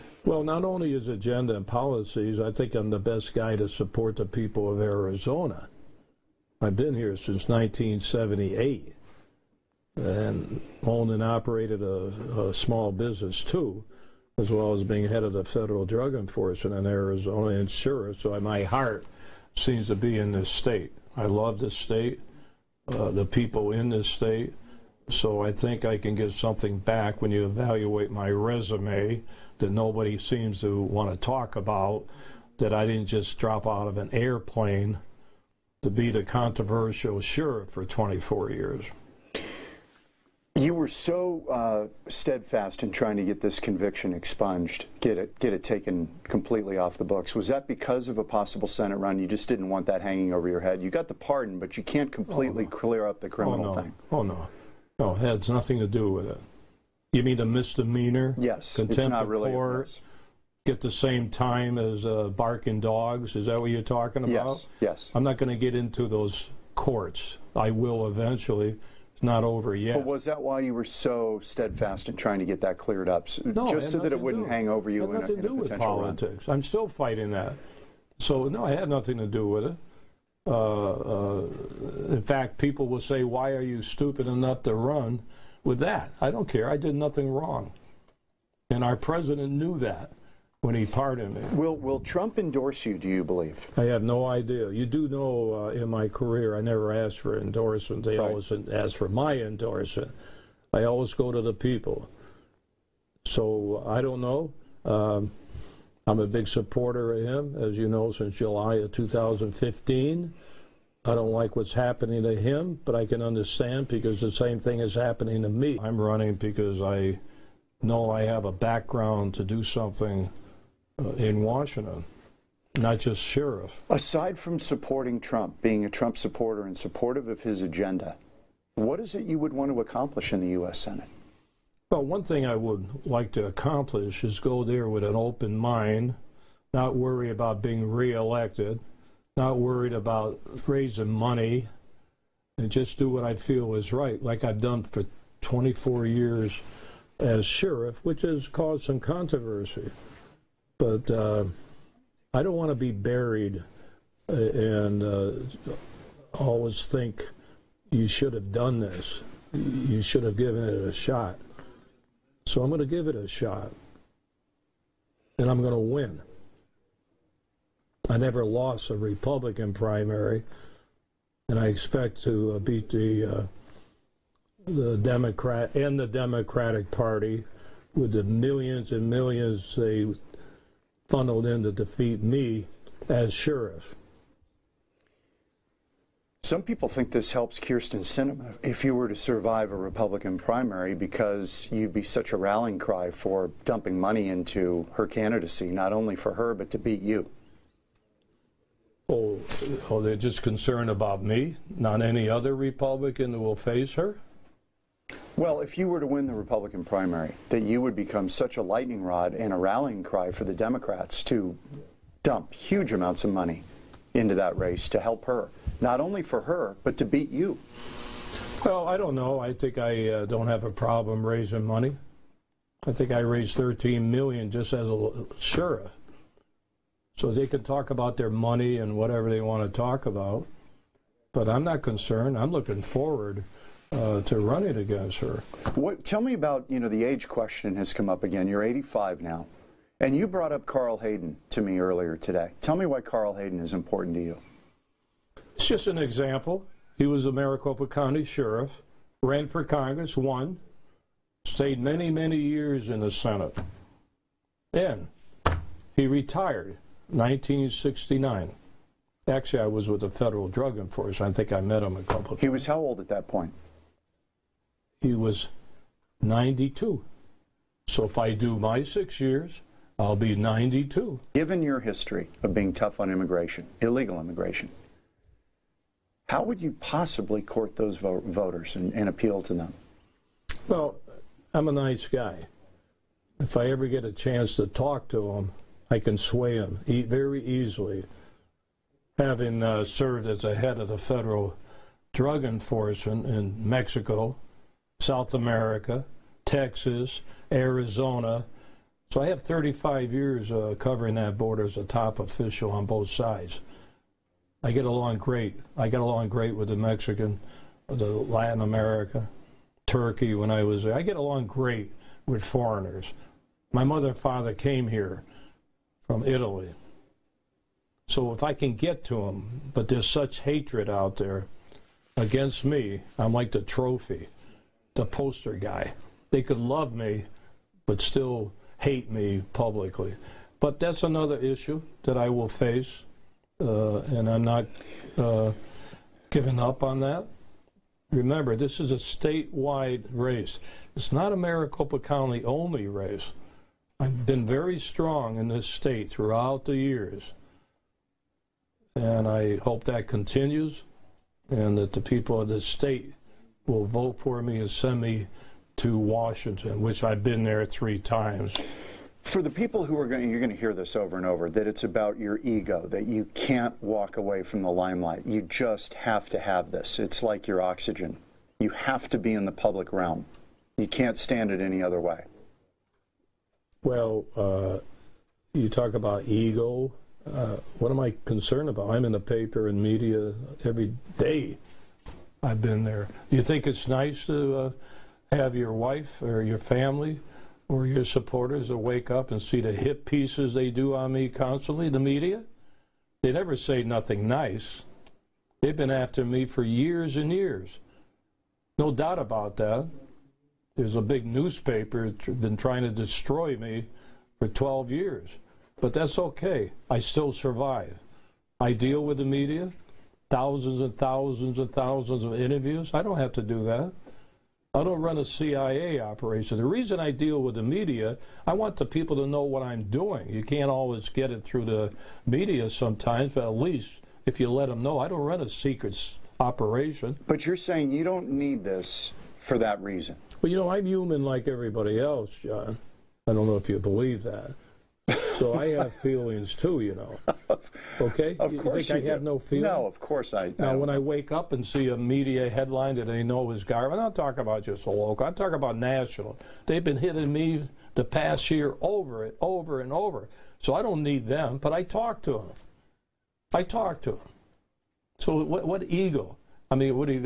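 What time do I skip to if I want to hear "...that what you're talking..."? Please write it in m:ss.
1:03.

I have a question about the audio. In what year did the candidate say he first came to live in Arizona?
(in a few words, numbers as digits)
1978.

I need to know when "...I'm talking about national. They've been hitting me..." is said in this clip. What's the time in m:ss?
7:25.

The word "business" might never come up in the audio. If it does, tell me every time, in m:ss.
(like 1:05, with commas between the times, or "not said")
0:12.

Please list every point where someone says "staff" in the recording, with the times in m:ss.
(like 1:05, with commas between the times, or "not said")
not said.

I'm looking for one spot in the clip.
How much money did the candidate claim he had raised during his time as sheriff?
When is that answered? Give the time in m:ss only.
3:43.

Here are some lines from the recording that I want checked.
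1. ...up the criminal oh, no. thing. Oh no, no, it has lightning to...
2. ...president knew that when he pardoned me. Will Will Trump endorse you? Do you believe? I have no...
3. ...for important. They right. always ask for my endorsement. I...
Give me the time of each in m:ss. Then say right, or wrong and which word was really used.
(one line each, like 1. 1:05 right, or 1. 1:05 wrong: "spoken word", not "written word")
1. 0:53 wrong: "nothing", not "lightning"
2. 1:28 right
3. 1:37 wrong: "endorsement", not "important".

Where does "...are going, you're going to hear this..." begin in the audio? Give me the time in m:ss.
5:59.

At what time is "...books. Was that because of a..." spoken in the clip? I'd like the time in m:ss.
0:47.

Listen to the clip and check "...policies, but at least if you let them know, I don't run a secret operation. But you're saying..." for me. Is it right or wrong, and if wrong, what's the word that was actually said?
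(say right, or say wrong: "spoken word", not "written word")
wrong: "sometimes", not "policies".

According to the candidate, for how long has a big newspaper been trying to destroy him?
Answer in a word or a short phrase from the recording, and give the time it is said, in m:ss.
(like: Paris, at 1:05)
12 years, at 6:44.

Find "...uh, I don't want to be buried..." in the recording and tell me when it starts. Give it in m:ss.
2:31.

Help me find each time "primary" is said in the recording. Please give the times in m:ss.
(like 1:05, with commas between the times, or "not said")
2:49, 3:10, 3:26.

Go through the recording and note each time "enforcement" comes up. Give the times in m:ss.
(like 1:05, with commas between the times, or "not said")
0:16, 4:20, 4:52.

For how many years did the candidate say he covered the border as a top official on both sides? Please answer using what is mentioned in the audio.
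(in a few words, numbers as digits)
35.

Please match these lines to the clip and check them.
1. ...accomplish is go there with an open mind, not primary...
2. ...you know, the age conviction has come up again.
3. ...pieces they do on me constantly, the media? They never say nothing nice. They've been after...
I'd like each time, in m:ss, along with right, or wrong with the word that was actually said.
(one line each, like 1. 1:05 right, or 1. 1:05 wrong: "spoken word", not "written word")
1. 2:13 wrong: "worry", not "primary"
2. 3:56 wrong: "question", not "conviction"
3. 6:30 right.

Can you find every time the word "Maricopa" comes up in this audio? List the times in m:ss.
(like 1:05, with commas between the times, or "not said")
4:07, 5:41.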